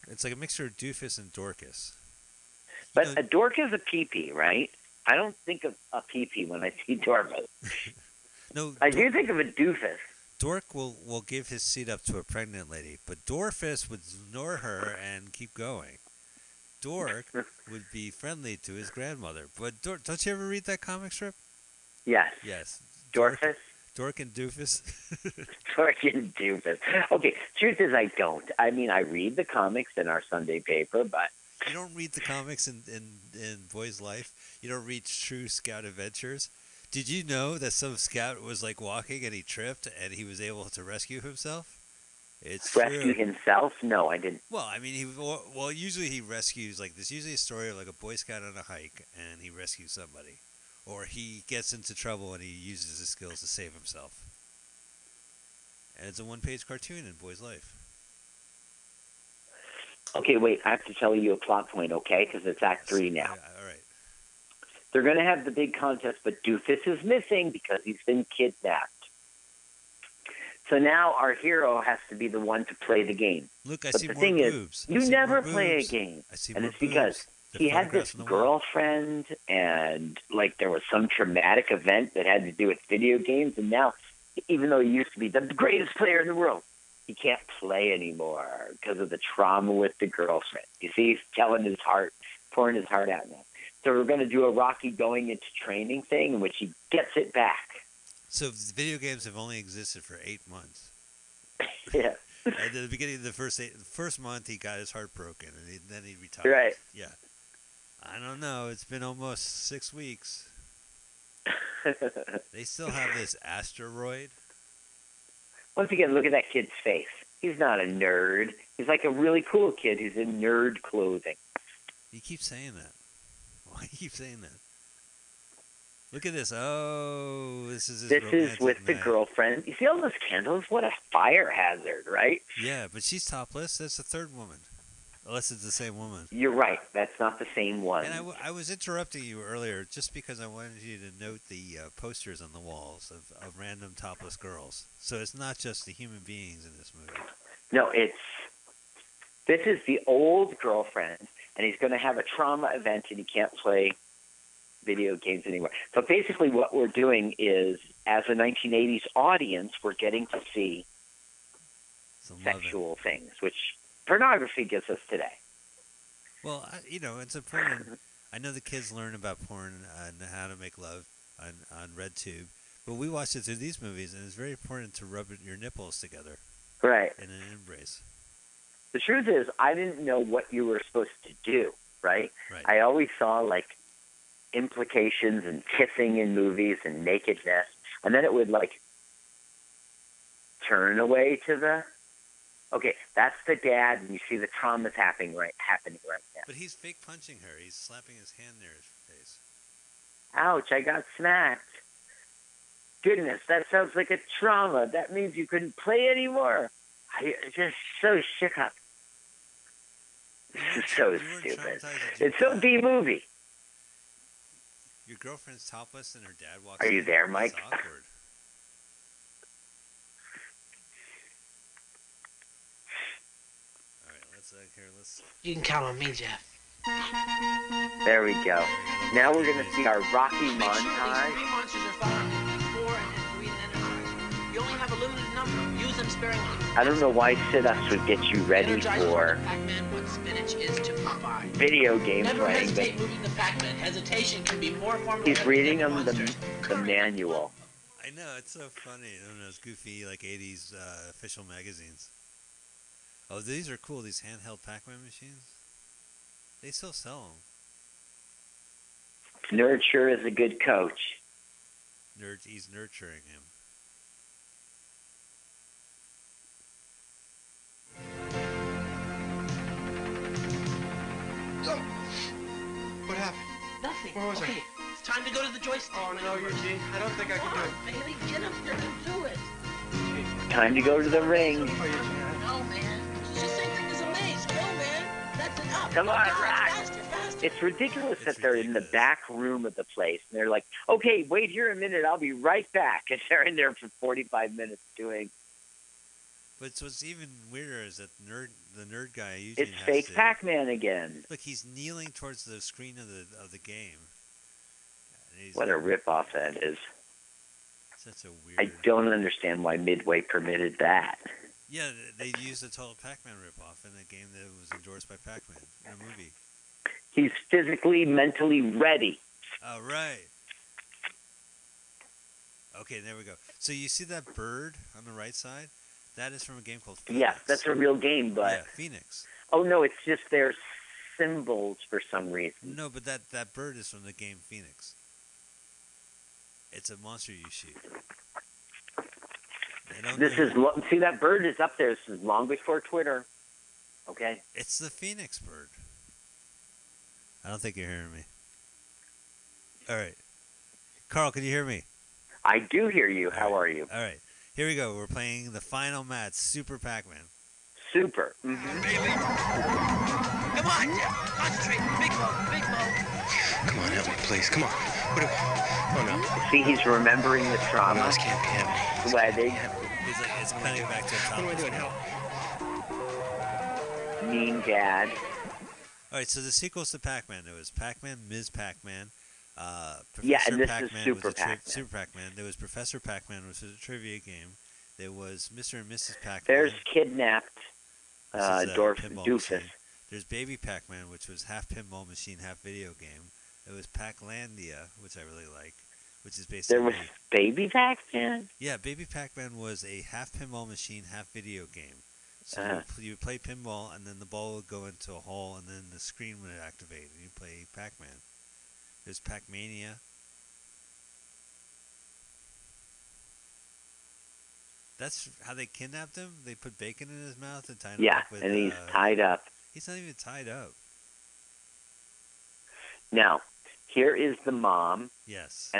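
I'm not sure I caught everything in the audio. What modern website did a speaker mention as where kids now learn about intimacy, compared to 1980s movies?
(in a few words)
RedTube.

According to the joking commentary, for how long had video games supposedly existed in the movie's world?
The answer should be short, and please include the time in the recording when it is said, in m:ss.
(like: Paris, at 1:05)
8 months, at 1:40.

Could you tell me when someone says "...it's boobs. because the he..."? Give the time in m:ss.
1:16.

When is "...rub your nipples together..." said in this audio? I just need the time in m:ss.
2:55.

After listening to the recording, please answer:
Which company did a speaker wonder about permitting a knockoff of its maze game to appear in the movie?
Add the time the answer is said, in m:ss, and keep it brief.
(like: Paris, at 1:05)
Midway, at 5:09.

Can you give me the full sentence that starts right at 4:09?
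don't know, those goofy like '80s uh, official magazines.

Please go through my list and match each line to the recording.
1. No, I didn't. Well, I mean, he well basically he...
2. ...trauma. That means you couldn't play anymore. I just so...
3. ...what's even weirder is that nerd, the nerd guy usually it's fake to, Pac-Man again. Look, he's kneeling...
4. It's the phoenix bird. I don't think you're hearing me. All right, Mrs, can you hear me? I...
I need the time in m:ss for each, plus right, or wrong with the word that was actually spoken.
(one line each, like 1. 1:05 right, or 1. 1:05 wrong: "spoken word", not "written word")
1. 0:43 wrong: "usually", not "basically"
2. 3:24 right
3. 4:56 right
4. 5:44 wrong: "Carl", not "Mrs".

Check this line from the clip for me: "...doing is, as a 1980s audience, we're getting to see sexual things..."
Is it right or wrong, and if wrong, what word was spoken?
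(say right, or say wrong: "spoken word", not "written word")
right.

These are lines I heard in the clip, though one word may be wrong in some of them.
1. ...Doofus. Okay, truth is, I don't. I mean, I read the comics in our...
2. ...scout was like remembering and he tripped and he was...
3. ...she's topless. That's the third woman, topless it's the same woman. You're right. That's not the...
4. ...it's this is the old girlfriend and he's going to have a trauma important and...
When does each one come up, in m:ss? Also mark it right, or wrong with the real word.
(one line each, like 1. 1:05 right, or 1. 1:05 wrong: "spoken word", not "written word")
1. 0:26 right
2. 0:37 wrong: "walking", not "remembering"
3. 2:13 wrong: "unless", not "topless"
4. 2:27 wrong: "event", not "important".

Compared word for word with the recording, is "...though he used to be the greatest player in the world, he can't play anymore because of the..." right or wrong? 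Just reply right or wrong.
right.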